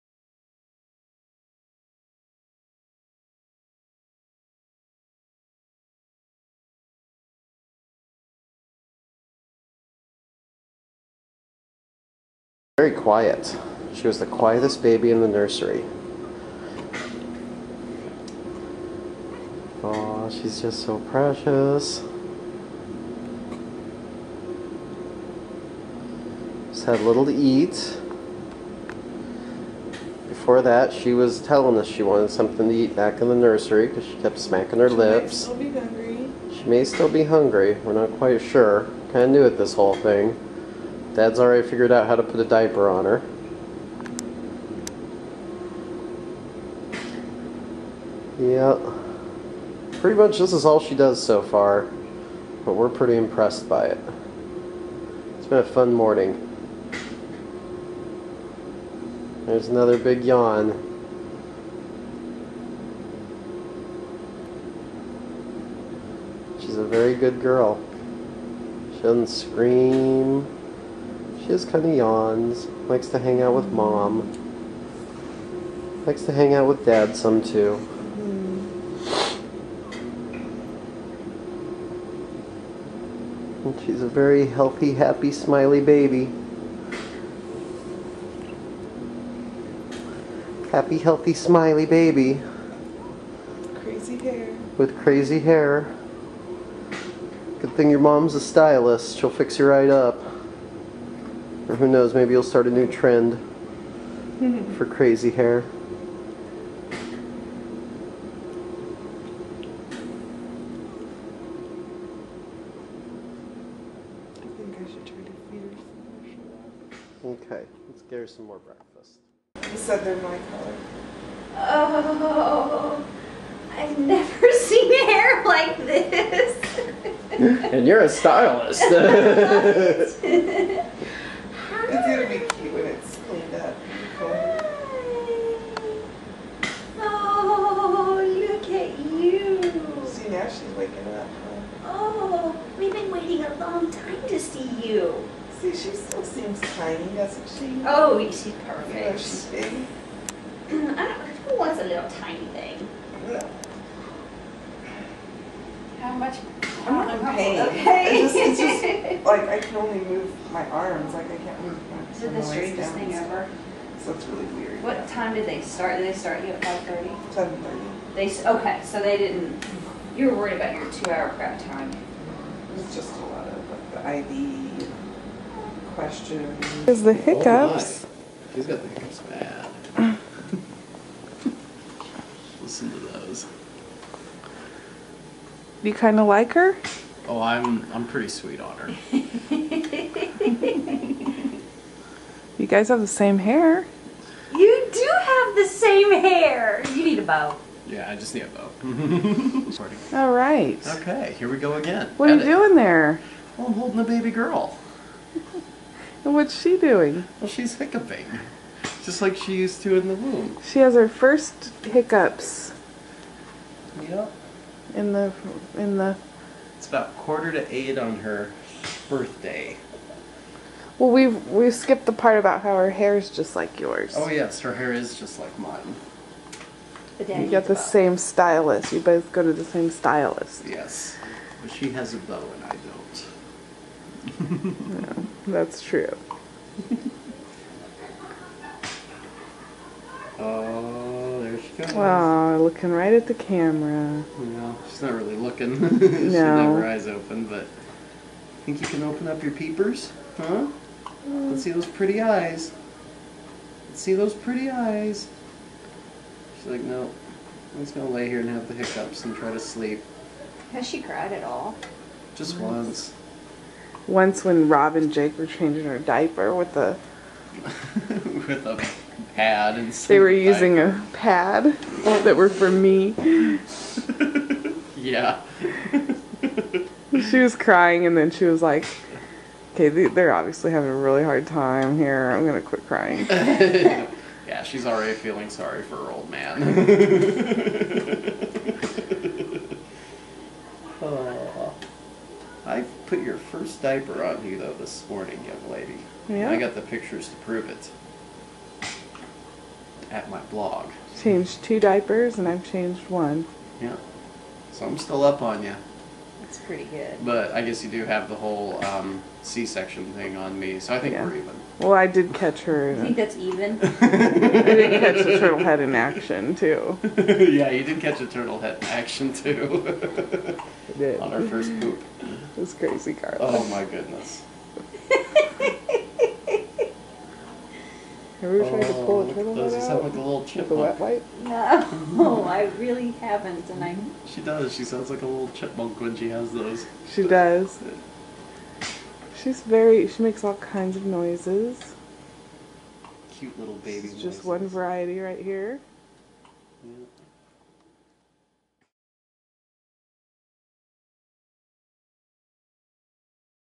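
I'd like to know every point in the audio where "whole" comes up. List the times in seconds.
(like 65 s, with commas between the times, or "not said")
39 s, 308 s.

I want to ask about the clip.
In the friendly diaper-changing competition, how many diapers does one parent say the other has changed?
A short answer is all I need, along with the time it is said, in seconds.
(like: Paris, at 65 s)
2, at 301 s.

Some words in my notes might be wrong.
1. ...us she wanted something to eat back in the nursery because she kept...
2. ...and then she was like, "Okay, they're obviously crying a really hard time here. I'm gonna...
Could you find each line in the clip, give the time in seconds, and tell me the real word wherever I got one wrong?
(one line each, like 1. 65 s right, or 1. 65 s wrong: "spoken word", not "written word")
1. 31 s right
2. 278 s wrong: "having", not "crying".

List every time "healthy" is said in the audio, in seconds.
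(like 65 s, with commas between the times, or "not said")
84 s, 90 s.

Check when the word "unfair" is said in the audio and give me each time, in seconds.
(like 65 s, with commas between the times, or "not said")
not said.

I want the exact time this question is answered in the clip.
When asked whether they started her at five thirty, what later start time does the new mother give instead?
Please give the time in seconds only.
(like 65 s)
167 s.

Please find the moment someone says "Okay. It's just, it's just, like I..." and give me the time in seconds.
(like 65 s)
157 s.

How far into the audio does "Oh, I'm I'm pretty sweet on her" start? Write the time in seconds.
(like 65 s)
187 s.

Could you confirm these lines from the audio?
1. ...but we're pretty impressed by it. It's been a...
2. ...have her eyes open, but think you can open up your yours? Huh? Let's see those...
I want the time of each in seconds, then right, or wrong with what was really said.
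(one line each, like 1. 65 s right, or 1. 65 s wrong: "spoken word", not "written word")
1. 52 s right
2. 246 s wrong: "peepers", not "yours".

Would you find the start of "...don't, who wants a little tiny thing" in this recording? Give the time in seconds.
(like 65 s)
151 s.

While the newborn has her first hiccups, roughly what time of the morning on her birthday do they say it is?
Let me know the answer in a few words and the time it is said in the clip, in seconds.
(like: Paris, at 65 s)
quarter to eight, at 217 s.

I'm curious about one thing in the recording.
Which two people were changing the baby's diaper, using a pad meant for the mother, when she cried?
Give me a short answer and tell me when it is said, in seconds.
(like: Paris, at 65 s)
Rob and Jake, at 264 s.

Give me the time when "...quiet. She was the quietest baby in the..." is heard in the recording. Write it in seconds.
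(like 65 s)
12 s.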